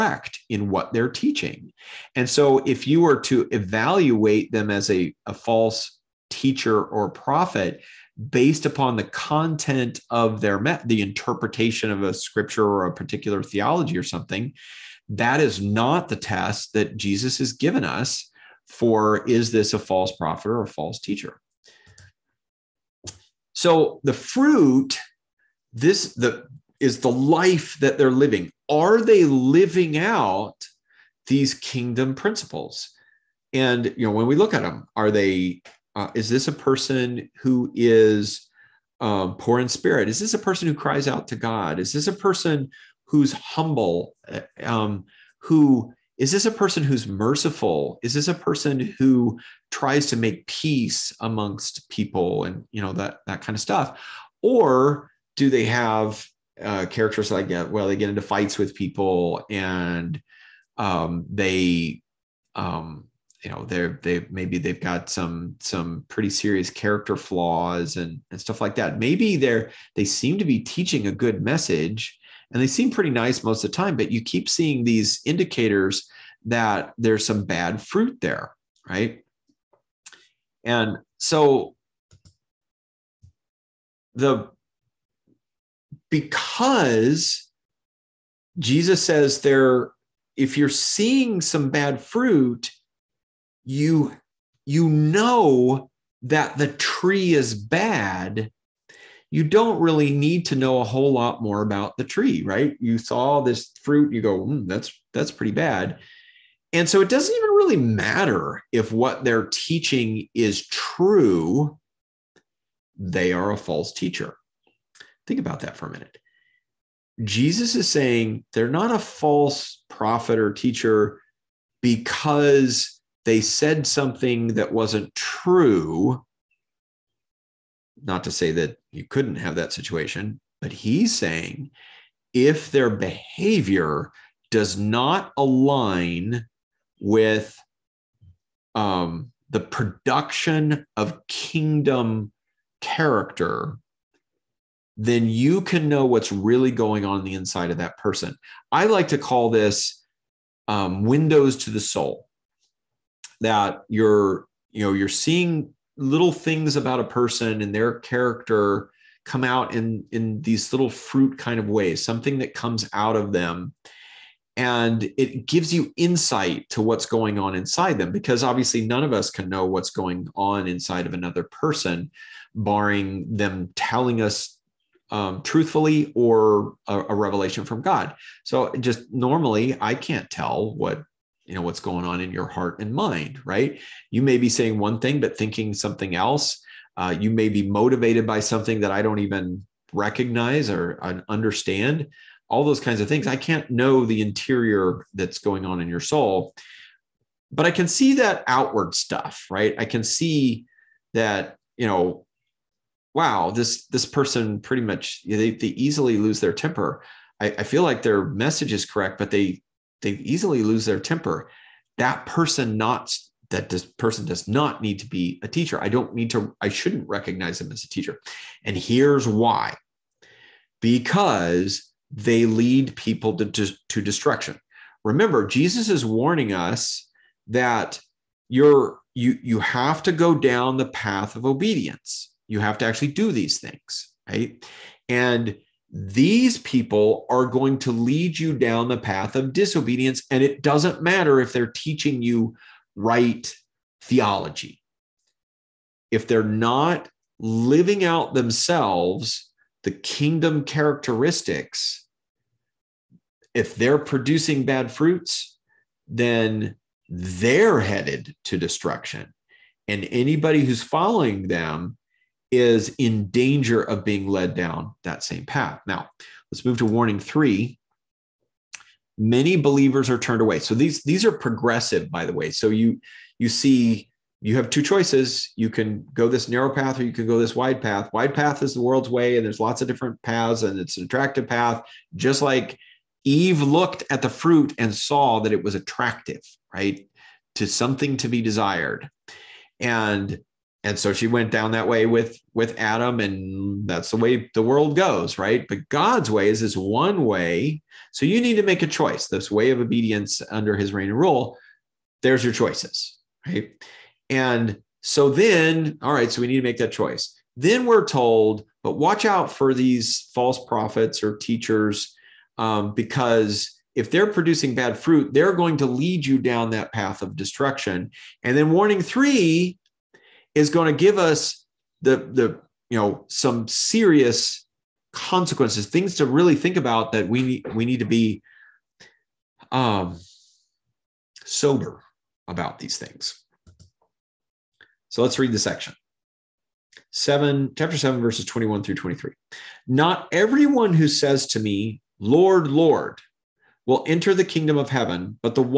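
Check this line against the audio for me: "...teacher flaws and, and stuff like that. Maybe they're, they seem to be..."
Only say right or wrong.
wrong.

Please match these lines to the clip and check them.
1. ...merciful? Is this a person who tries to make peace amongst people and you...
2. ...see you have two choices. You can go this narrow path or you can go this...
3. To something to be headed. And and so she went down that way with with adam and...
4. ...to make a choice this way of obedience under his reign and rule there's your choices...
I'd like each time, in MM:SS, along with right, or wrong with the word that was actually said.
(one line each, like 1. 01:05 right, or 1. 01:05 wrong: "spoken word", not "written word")
1. 00:47 right
2. 04:33 right
3. 04:47 wrong: "desired", not "headed"
4. 04:58 right.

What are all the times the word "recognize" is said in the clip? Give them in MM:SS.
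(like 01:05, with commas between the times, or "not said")
03:09, 03:37.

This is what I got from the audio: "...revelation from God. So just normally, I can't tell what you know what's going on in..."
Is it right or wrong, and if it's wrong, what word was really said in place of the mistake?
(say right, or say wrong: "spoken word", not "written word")
right.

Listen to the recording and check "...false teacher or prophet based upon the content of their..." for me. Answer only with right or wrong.
right.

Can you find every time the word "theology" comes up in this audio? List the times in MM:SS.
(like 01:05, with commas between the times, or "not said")
00:13, 04:04.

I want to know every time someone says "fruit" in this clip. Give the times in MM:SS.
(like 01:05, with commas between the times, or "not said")
00:24, 01:17, 01:31, 01:43, 02:40, 04:14, 04:44, 05:14.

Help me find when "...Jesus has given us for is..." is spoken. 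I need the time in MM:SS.
00:16.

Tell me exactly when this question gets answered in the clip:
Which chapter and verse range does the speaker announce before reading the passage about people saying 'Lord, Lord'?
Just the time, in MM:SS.
05:37.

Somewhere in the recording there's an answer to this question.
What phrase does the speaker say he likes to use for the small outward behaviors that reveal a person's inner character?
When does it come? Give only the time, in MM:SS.
02:31.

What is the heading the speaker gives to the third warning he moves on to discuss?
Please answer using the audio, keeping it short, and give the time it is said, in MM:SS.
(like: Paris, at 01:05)
Many believers are turned away, at 04:29.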